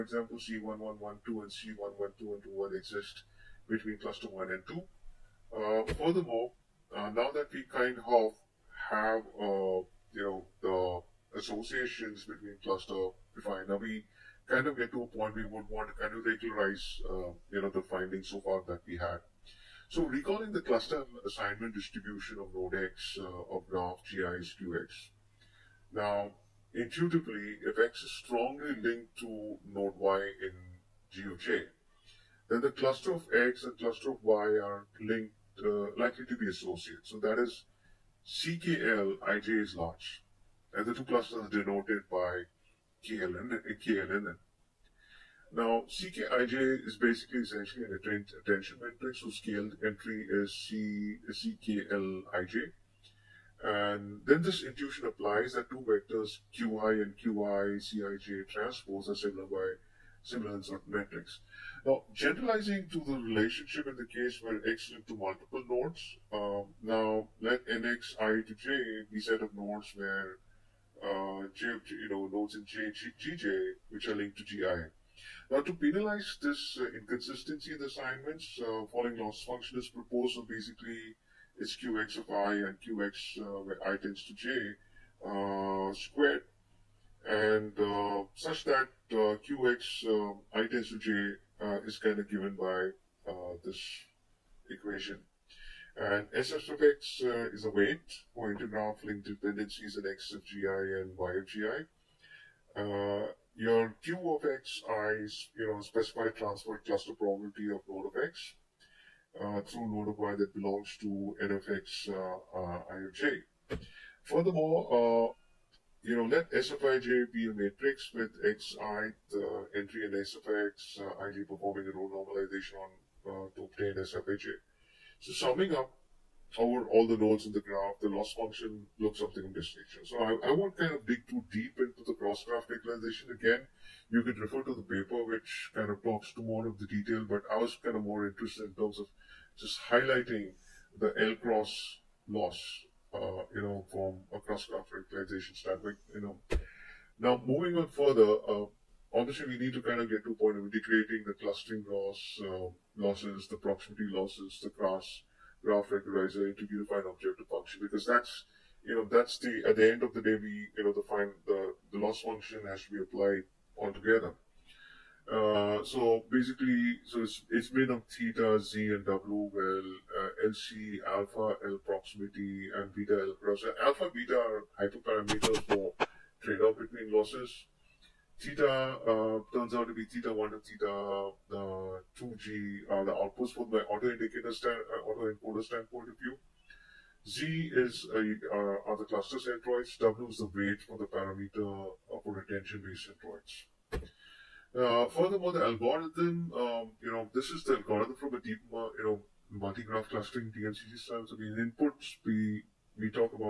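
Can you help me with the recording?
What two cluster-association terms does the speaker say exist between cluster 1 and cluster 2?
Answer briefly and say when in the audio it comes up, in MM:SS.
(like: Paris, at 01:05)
C1112 and C1121, at 00:00.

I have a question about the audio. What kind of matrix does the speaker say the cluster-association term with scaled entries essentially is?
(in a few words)
attention matrix.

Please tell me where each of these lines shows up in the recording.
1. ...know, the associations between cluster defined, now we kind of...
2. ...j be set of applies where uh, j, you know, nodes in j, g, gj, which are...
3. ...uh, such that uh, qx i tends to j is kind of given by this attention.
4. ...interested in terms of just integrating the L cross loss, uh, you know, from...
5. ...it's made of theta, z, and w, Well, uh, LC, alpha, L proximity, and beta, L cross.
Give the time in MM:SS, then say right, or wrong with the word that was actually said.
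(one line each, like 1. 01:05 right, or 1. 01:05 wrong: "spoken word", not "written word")
1. 00:10 right
2. 01:08 wrong: "nodes", not "applies"
3. 01:27 wrong: "equation", not "attention"
4. 02:18 wrong: "highlighting", not "integrating"
5. 02:47 right.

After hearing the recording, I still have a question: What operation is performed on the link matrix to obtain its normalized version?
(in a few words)
row normalization.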